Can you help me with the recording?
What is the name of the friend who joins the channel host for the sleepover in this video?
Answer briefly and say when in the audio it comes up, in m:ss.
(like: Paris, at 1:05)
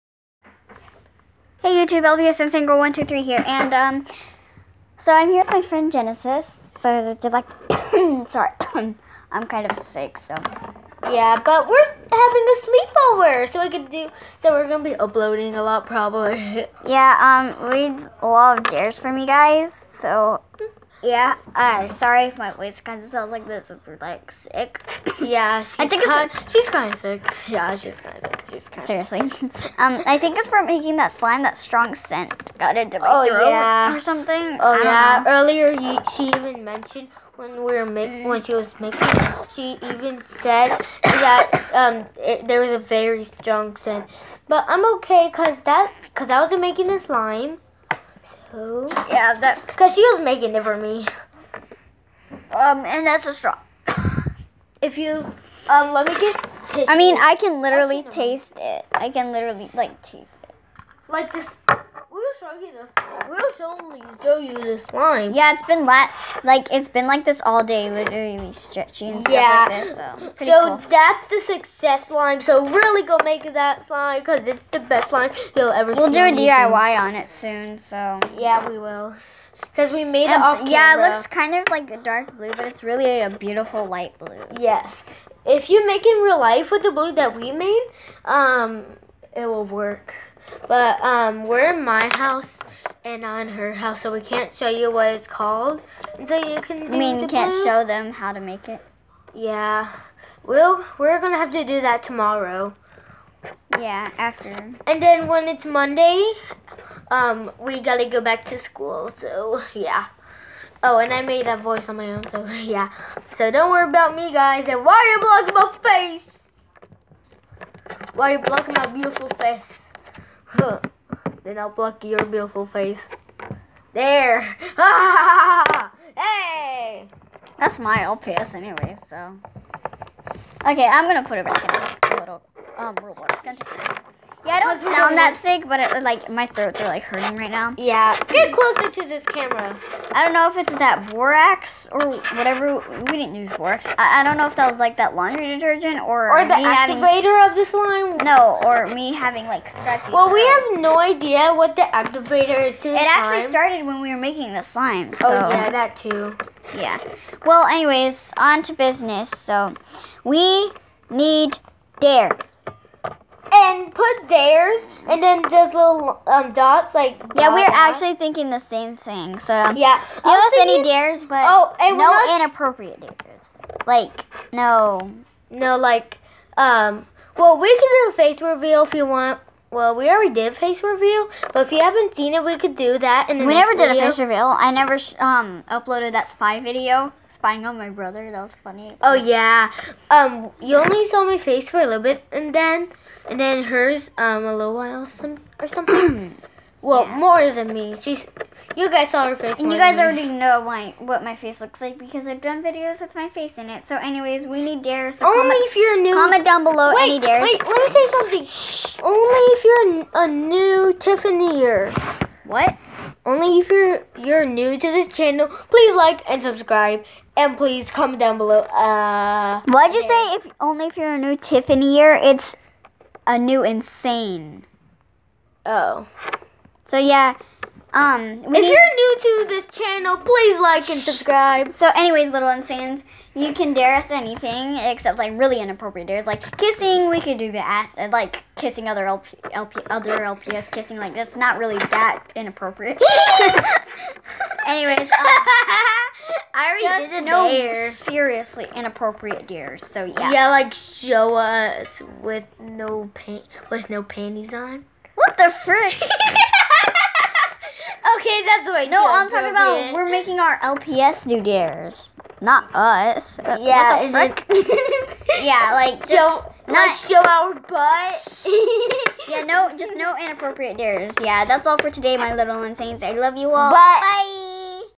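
Genesis, at 0:05.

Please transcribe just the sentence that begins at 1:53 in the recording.
So don't worry about me, guys.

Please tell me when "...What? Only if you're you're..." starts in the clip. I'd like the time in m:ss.
3:32.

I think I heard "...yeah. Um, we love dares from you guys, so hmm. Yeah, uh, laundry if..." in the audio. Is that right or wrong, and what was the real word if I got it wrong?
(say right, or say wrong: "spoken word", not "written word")
wrong: "sorry", not "laundry".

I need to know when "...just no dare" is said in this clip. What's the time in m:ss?
4:06.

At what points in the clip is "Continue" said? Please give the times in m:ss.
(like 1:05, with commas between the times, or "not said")
2:13.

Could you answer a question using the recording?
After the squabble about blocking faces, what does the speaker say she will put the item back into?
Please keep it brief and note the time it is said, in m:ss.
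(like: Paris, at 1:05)
Roblox, at 2:12.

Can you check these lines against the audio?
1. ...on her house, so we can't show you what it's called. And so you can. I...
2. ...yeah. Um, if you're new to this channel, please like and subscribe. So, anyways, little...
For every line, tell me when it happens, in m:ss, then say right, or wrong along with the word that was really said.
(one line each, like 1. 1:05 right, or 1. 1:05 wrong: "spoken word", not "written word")
1. 1:33 right
2. 3:46 right.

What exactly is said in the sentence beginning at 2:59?
Well, we already did face reveal, but if you haven't seen it, we could do that.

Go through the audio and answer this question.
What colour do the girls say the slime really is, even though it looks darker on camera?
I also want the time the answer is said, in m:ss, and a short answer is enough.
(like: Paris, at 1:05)
Light blue, at 1:23.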